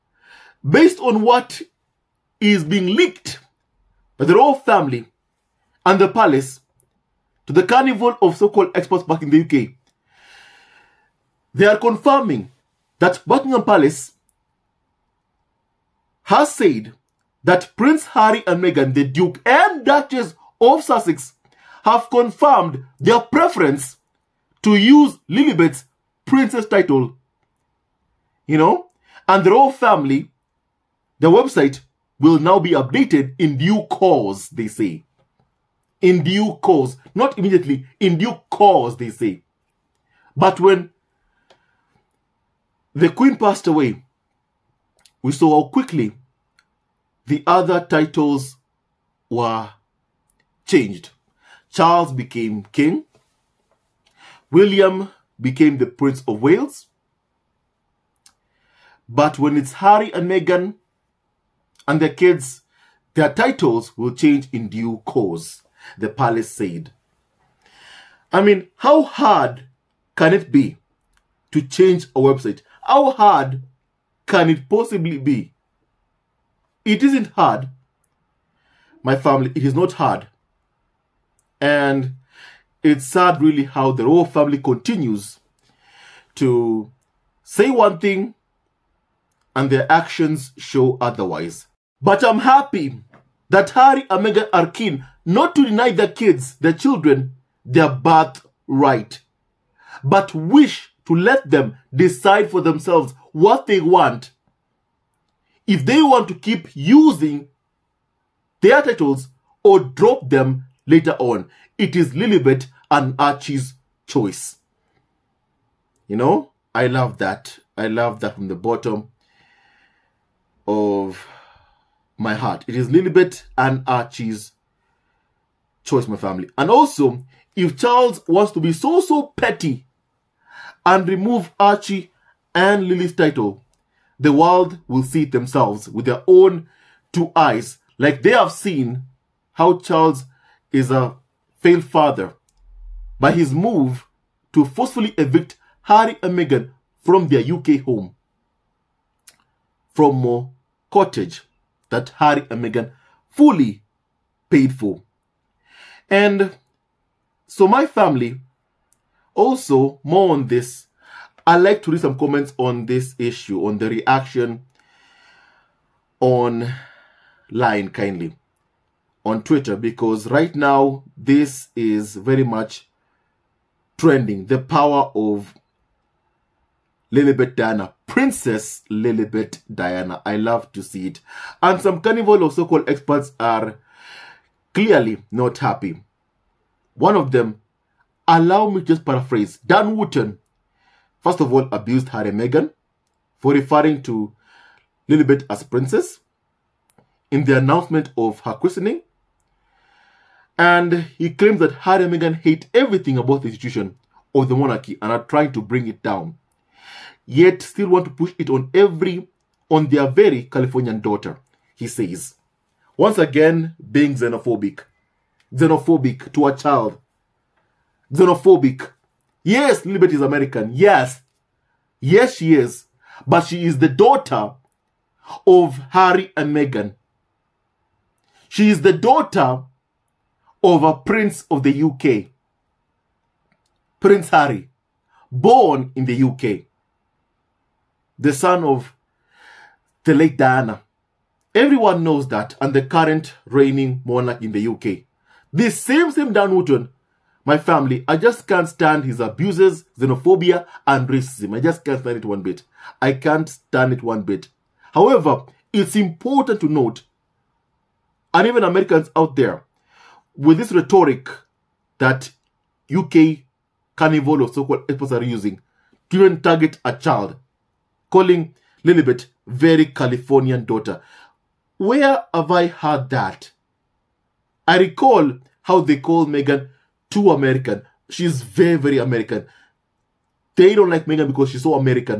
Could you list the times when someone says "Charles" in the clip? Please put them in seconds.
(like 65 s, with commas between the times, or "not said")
51 s, 127 s, 139 s.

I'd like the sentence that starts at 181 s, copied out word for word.
And some carnival of so-called experts are clearly not happy.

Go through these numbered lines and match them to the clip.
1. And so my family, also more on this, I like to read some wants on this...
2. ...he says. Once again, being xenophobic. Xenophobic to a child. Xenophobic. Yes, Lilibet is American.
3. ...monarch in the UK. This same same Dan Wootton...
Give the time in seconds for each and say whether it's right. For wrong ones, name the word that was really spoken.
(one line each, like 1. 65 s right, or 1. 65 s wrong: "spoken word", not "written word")
1. 156 s wrong: "comments", not "wants"
2. 211 s right
3. 244 s right.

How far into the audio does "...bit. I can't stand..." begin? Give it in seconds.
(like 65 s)
252 s.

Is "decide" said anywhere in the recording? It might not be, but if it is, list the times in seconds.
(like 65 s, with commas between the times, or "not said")
101 s.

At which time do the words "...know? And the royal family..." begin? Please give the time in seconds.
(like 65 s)
28 s.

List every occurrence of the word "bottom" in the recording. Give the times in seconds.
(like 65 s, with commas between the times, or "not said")
118 s.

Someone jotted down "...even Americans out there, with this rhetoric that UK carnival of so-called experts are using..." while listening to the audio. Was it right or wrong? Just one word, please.
right.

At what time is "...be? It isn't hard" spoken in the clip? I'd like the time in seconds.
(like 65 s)
75 s.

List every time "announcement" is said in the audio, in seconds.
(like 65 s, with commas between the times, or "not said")
197 s.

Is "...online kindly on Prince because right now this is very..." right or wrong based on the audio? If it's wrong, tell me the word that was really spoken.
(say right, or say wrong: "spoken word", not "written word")
wrong: "Twitter", not "Prince".